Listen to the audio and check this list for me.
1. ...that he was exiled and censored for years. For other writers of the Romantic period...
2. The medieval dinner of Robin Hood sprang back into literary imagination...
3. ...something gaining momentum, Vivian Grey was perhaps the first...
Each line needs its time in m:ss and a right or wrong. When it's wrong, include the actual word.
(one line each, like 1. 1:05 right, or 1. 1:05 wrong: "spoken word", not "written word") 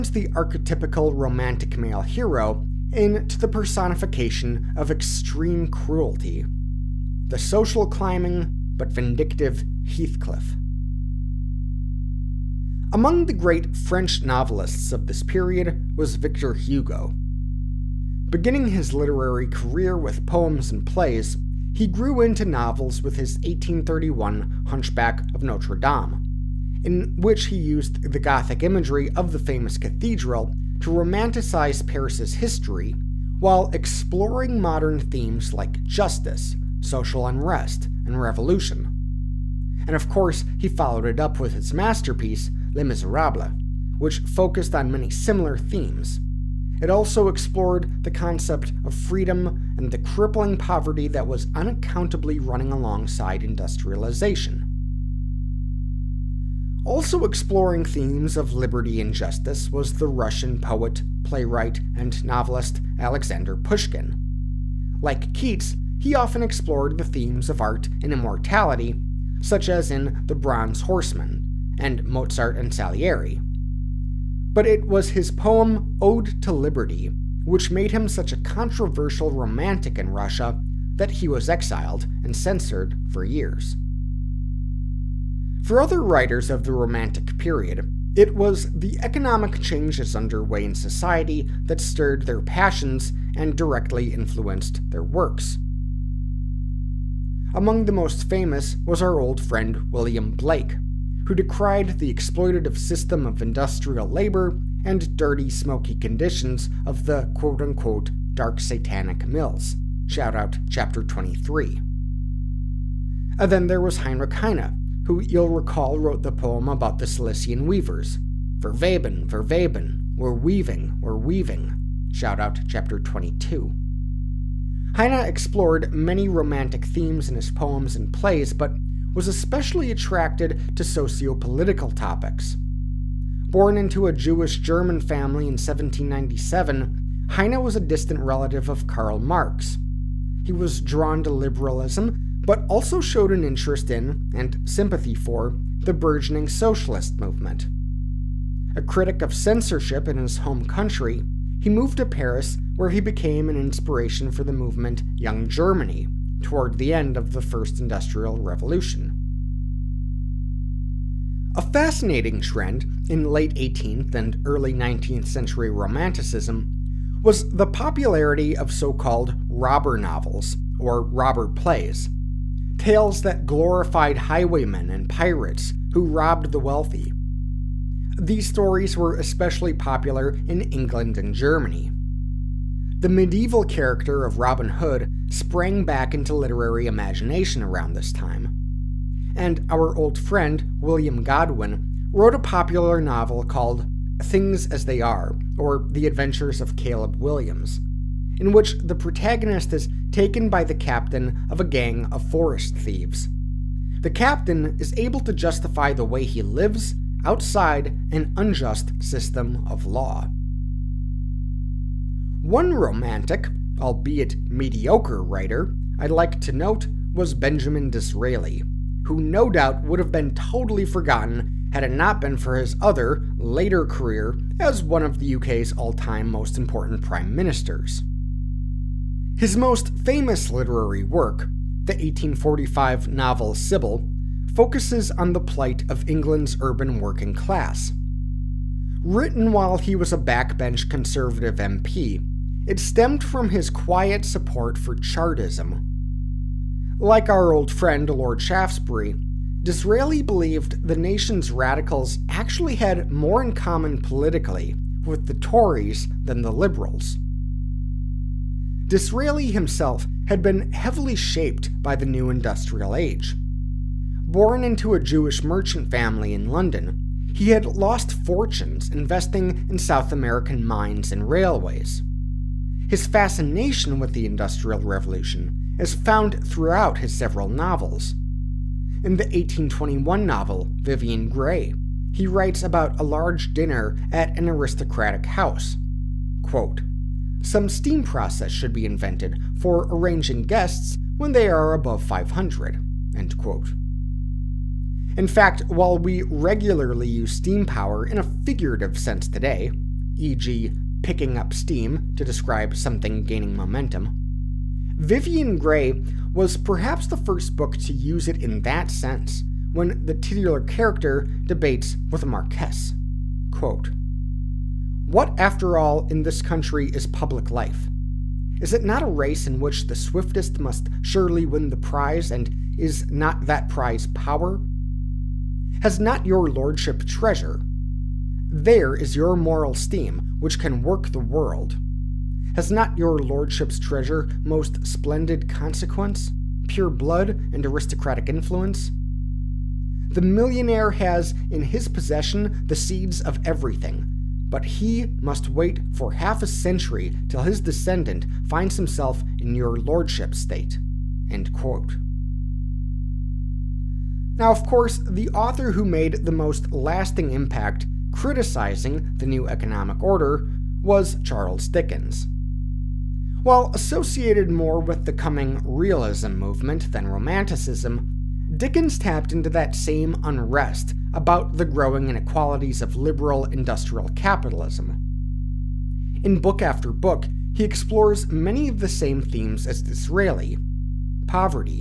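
1. 1:20 right
2. 3:03 wrong: "character", not "dinner"
3. 5:02 right.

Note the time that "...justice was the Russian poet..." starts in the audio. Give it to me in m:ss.
0:59.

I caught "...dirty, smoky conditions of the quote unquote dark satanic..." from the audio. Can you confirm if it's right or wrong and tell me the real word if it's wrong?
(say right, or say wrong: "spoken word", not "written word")
right.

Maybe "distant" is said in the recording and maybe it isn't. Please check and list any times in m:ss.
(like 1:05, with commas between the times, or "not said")
2:17.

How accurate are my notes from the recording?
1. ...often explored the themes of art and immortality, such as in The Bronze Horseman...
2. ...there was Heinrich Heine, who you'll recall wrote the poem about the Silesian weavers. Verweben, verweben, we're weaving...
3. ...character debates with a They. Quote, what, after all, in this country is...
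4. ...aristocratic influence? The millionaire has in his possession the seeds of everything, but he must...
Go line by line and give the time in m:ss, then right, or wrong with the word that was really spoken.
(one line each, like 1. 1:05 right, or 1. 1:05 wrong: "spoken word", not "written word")
1. 1:06 right
2. 1:53 right
3. 5:10 wrong: "Marquess", not "They"
4. 5:37 right.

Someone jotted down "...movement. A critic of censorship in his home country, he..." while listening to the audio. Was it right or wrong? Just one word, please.
right.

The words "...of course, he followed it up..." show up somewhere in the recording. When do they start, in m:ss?
0:39.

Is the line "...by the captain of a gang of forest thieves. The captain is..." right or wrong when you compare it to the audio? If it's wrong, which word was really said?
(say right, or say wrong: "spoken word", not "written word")
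right.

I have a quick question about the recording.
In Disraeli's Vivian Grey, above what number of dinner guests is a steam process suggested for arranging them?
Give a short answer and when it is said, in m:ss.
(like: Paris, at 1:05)
500, at 4:52.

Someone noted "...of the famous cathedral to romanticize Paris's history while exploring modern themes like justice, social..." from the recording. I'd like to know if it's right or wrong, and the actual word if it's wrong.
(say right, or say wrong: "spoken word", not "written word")
right.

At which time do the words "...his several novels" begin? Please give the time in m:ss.
4:36.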